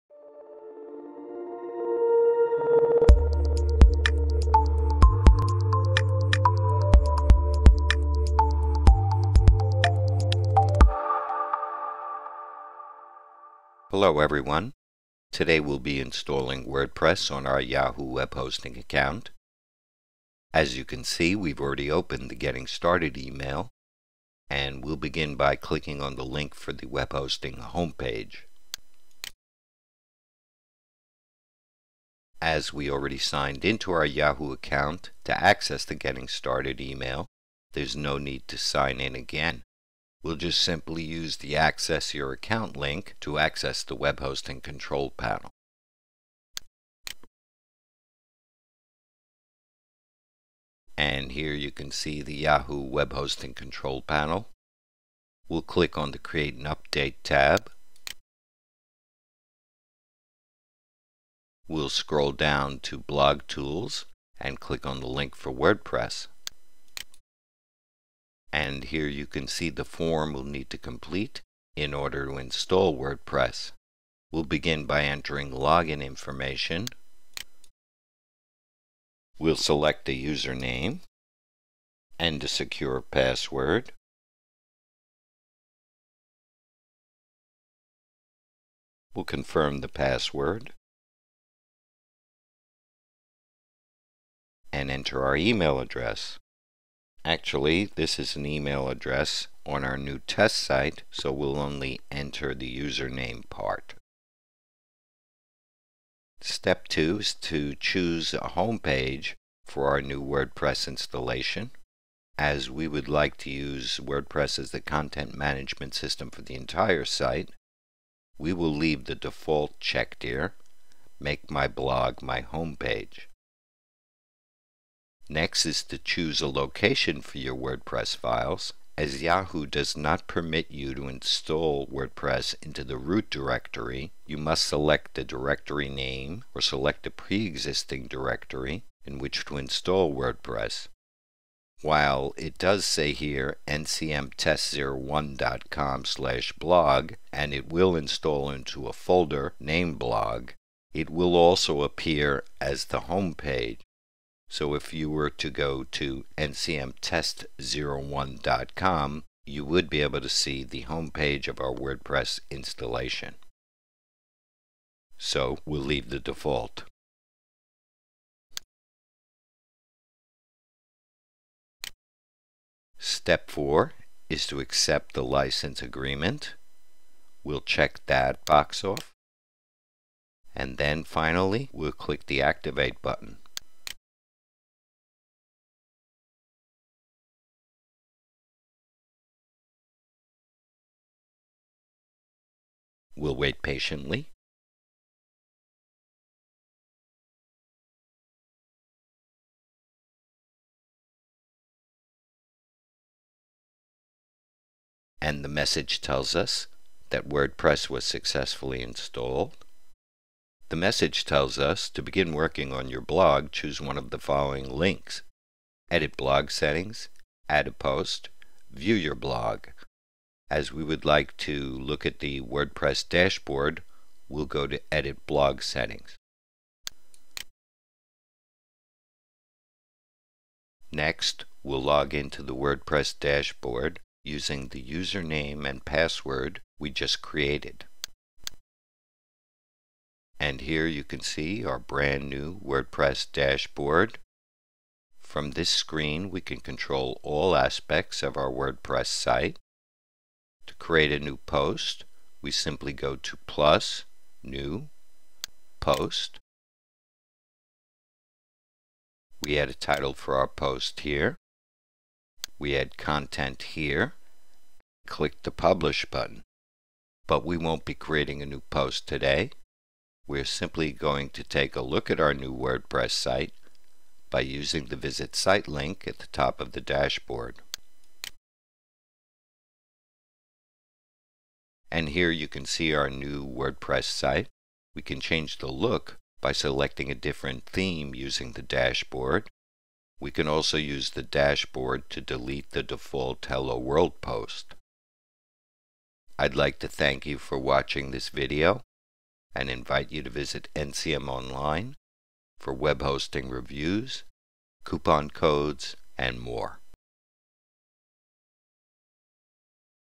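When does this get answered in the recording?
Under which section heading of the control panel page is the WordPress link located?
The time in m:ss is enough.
1:02.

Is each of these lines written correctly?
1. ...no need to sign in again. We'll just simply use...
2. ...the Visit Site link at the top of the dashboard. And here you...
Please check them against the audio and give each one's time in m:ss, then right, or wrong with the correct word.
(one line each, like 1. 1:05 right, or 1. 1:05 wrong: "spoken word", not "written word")
1. 0:37 right
2. 4:34 right.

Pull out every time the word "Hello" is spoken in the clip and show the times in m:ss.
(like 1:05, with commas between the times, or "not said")
0:13, 4:53.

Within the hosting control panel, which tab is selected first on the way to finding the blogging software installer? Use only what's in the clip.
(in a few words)
Create and Update.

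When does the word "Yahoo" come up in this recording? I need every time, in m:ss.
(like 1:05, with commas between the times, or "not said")
0:17, 0:34, 0:52, 2:09.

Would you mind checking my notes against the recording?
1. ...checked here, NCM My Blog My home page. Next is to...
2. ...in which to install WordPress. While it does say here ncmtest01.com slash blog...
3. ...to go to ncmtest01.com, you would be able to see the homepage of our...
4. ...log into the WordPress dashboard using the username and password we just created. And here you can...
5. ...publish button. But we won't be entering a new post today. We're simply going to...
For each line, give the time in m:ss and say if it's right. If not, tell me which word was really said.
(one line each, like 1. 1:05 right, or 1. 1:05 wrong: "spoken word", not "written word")
1. 1:59 wrong: "Make", not "NCM"
2. 2:19 right
3. 2:35 right
4. 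3:51 right
5. 4:25 wrong: "creating", not "entering".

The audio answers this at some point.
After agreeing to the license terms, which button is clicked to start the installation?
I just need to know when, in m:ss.
3:02.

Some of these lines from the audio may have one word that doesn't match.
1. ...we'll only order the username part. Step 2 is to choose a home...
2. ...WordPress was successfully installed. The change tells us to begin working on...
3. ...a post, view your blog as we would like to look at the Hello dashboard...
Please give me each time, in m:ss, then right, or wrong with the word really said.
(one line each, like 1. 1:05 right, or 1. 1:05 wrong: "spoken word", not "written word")
1. 1:41 wrong: "enter", not "order"
2. 3:27 wrong: "message", not "change"
3. 3:37 wrong: "WordPress", not "Hello".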